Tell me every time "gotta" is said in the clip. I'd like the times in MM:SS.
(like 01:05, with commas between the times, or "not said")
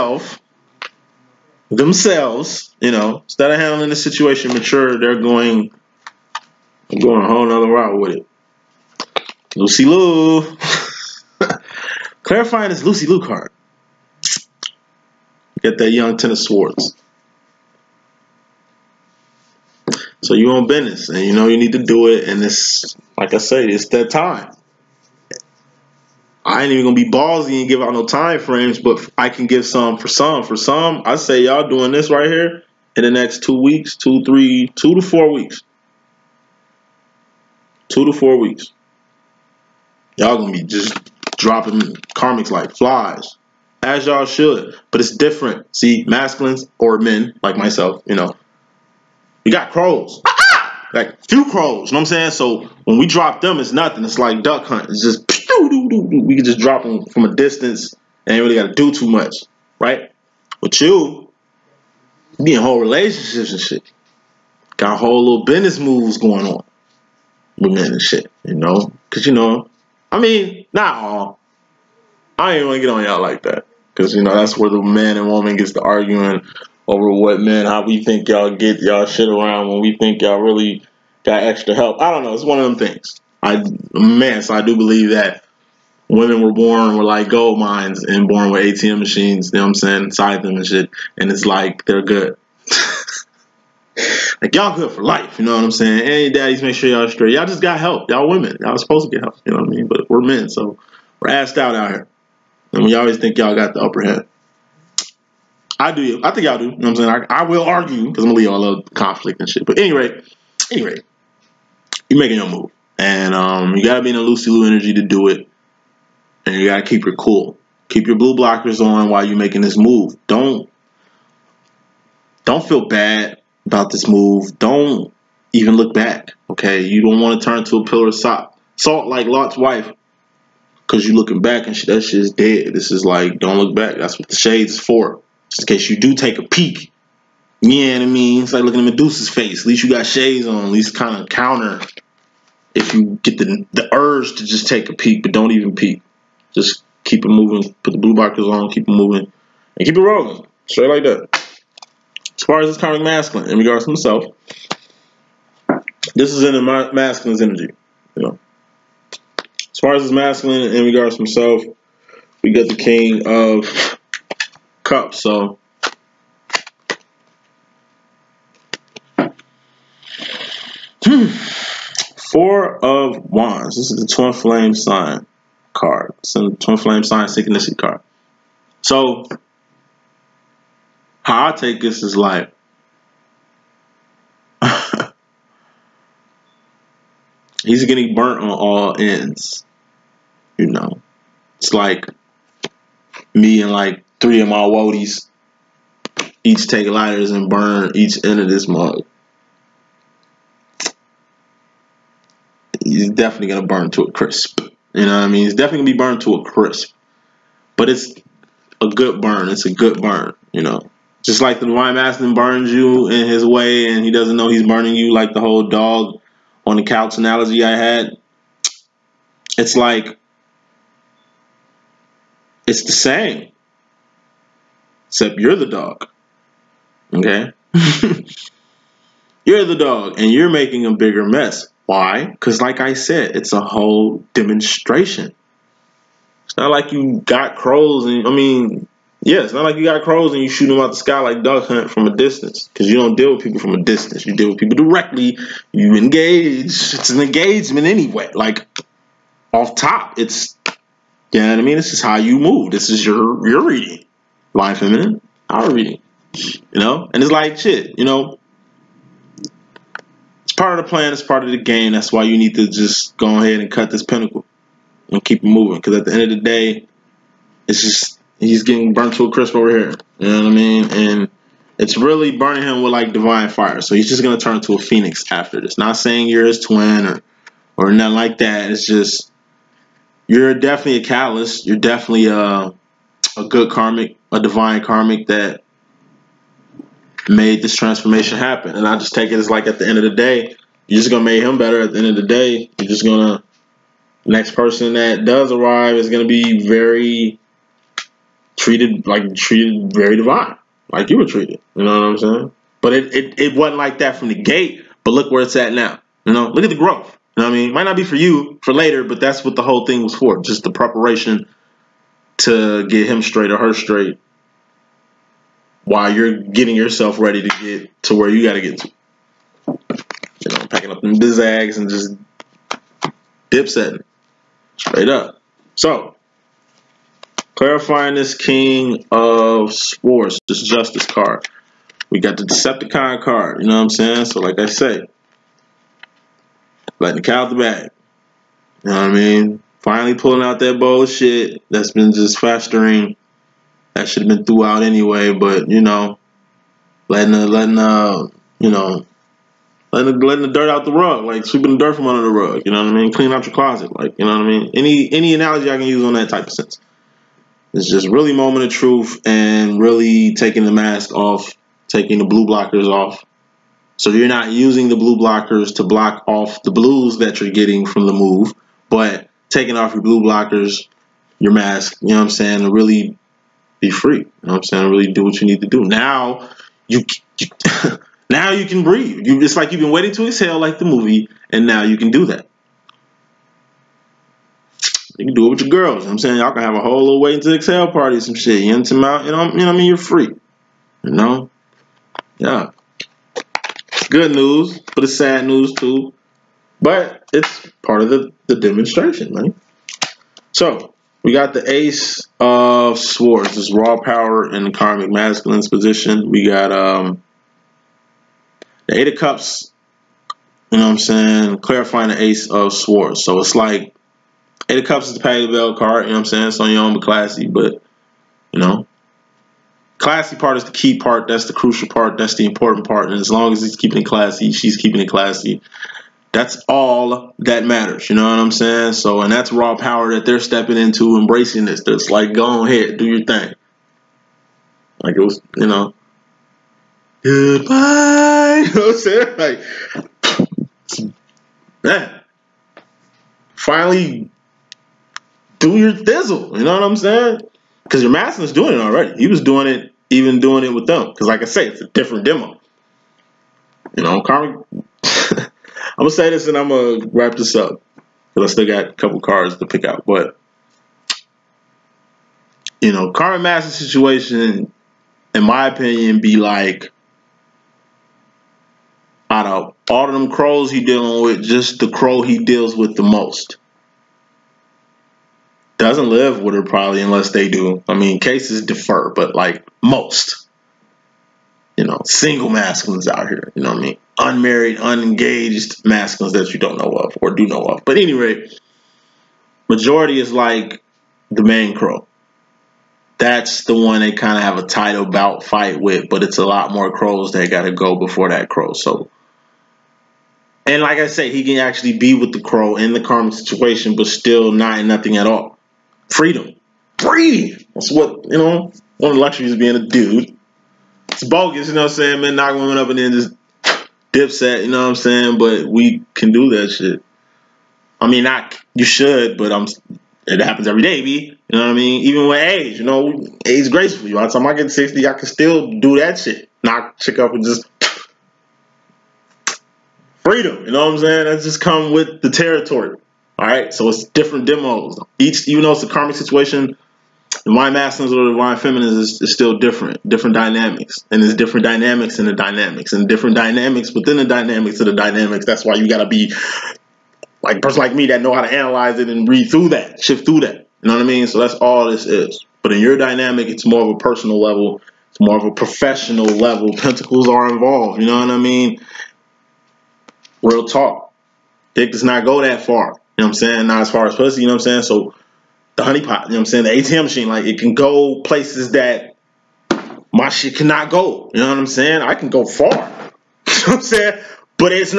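00:58, 09:05.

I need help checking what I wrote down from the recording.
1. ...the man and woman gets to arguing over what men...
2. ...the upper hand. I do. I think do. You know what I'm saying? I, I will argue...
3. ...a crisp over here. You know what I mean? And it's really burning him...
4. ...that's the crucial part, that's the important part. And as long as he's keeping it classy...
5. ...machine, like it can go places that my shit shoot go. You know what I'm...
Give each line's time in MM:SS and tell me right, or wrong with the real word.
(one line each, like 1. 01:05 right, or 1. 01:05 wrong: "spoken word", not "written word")
1. 01:14 right
2. 01:43 right
3. 04:29 right
4. 07:01 right
5. 09:27 wrong: "cannot", not "shoot".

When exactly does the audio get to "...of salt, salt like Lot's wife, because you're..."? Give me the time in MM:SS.
02:08.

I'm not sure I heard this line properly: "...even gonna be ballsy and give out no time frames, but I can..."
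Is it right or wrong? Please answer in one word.
right.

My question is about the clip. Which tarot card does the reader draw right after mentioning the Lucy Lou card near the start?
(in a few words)
Ten of Swords.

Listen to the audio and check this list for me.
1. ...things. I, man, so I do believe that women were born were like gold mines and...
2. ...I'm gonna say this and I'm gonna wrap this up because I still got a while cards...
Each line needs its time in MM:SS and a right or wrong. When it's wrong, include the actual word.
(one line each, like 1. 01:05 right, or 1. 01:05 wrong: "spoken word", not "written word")
1. 01:22 right
2. 07:35 wrong: "couple", not "while".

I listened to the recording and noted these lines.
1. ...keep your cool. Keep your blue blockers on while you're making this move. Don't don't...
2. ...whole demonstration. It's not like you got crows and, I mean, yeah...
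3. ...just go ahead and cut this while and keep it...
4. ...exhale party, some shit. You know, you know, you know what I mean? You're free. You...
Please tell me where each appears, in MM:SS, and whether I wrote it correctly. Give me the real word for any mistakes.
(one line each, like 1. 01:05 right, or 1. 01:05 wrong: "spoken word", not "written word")
1. 01:56 right
2. 03:53 right
3. 04:22 wrong: "pinnacle", not "while"
4. 06:27 right.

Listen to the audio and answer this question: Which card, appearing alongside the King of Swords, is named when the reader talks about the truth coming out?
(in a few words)
Justice.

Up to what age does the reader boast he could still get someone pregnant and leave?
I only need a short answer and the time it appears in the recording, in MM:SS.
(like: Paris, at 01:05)
60, at 08:44.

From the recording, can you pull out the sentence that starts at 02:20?
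At least kind of counter if you get the the urge to just take a peek, but don't even peek.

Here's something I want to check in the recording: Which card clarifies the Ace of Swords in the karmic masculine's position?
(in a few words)
Eight of Cups.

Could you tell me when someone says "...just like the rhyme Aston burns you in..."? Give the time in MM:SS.
03:31.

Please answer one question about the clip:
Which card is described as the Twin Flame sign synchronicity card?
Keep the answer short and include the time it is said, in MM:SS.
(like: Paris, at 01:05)
Four of Wands, at 02:52.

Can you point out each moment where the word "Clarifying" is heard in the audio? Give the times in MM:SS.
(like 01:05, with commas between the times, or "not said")
00:12, 05:27, 06:51.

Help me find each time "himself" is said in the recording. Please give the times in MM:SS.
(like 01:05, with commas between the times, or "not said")
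02:33, 02:41.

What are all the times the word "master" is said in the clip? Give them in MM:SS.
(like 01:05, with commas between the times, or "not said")
07:28, 07:43.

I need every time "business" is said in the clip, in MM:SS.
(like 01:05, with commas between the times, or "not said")
00:20, 01:05.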